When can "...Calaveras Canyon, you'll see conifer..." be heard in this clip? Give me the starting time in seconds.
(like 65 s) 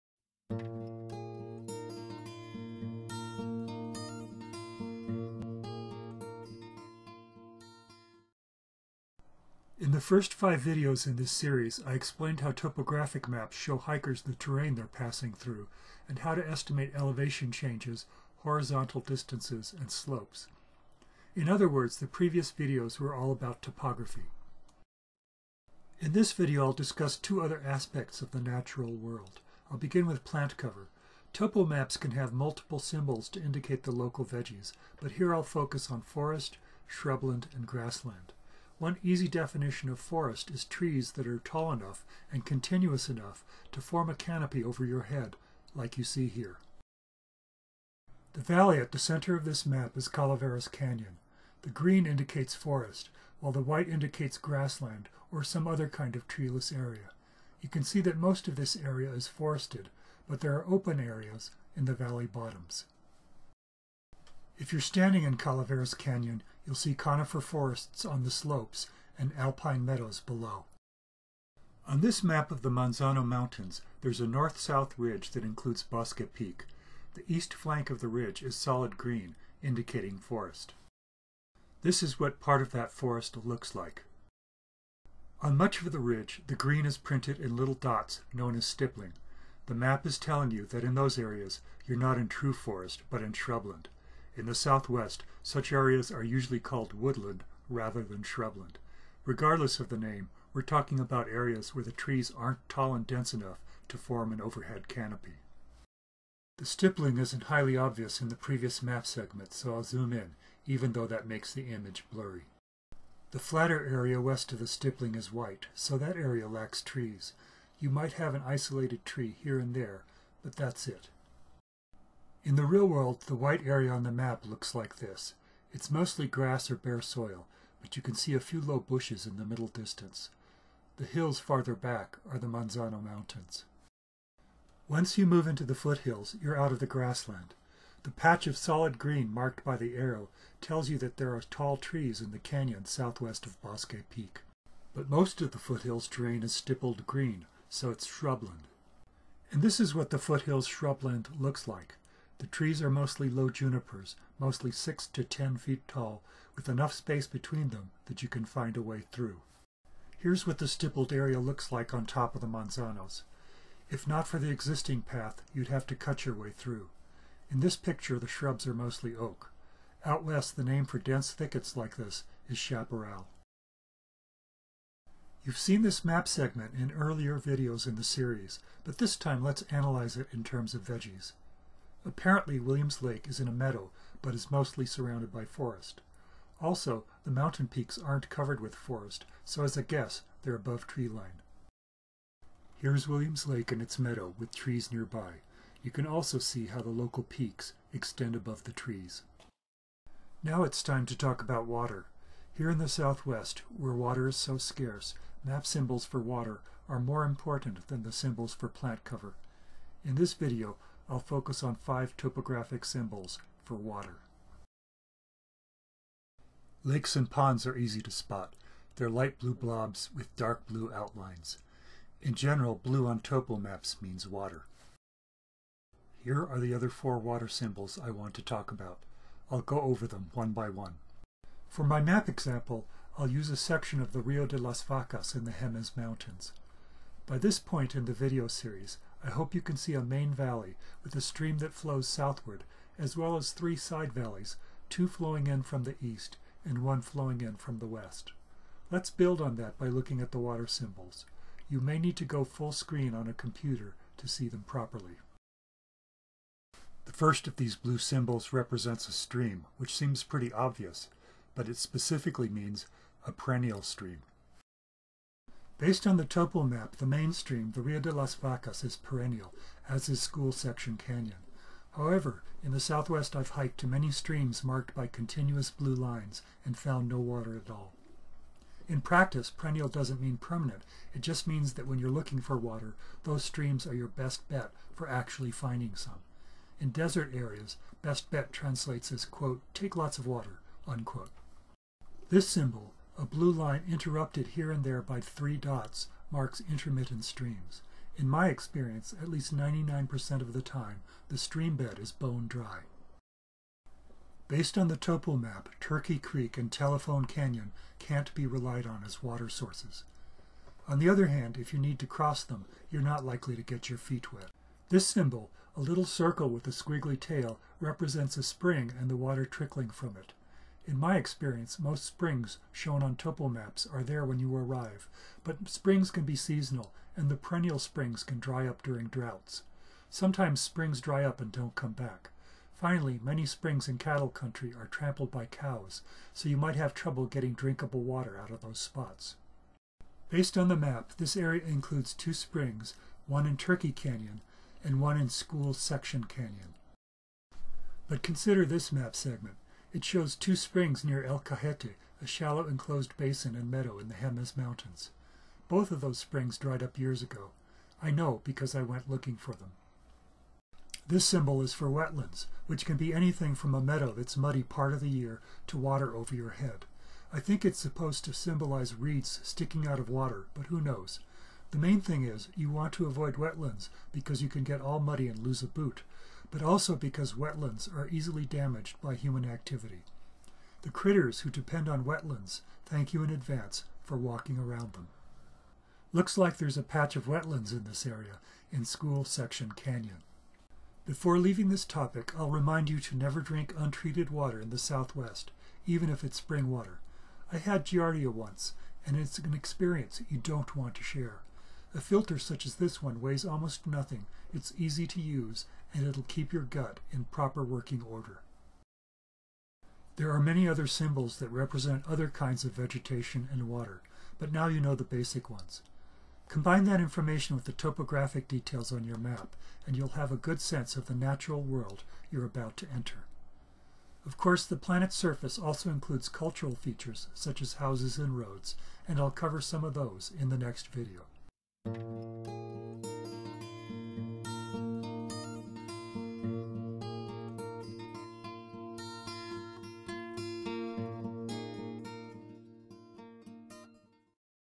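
65 s.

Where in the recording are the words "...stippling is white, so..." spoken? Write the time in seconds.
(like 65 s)
114 s.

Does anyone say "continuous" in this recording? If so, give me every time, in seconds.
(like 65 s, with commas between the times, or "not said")
42 s, 275 s.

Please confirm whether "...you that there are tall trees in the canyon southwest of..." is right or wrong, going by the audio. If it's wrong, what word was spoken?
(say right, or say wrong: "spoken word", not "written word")
right.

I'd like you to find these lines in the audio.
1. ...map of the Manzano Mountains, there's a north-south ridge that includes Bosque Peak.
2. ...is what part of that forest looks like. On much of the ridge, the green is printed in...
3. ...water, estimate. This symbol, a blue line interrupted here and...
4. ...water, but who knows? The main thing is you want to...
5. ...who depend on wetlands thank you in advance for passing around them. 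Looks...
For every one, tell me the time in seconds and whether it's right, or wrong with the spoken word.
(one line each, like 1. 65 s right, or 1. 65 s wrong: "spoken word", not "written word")
1. 72 s right
2. 82 s right
3. 290 s wrong: "unquote", not "estimate"
4. 370 s right
5. 381 s wrong: "walking", not "passing".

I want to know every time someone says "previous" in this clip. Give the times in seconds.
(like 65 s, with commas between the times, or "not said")
22 s, 108 s.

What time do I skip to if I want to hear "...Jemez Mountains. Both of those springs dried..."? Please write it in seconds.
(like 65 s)
354 s.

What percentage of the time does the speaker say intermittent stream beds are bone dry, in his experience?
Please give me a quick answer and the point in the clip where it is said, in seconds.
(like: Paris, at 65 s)
99%, at 299 s.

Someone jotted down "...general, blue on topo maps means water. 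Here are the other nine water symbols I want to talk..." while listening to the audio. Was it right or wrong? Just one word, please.
wrong.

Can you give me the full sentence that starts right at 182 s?
Apparently Williams Lake is in a meadow, but is mostly surrounded by forest.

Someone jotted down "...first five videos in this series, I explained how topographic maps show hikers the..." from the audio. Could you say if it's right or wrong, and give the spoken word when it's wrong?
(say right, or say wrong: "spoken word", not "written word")
right.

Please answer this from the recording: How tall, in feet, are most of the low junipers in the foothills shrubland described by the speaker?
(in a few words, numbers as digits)
6 to 10 feet.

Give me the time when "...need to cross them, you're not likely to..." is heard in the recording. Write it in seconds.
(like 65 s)
311 s.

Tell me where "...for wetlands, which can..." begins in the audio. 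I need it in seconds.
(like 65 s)
361 s.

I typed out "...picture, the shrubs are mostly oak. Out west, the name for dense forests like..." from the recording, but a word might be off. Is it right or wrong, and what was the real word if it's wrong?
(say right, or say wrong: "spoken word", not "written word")
wrong: "thickets", not "forests".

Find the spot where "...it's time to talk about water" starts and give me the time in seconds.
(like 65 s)
200 s.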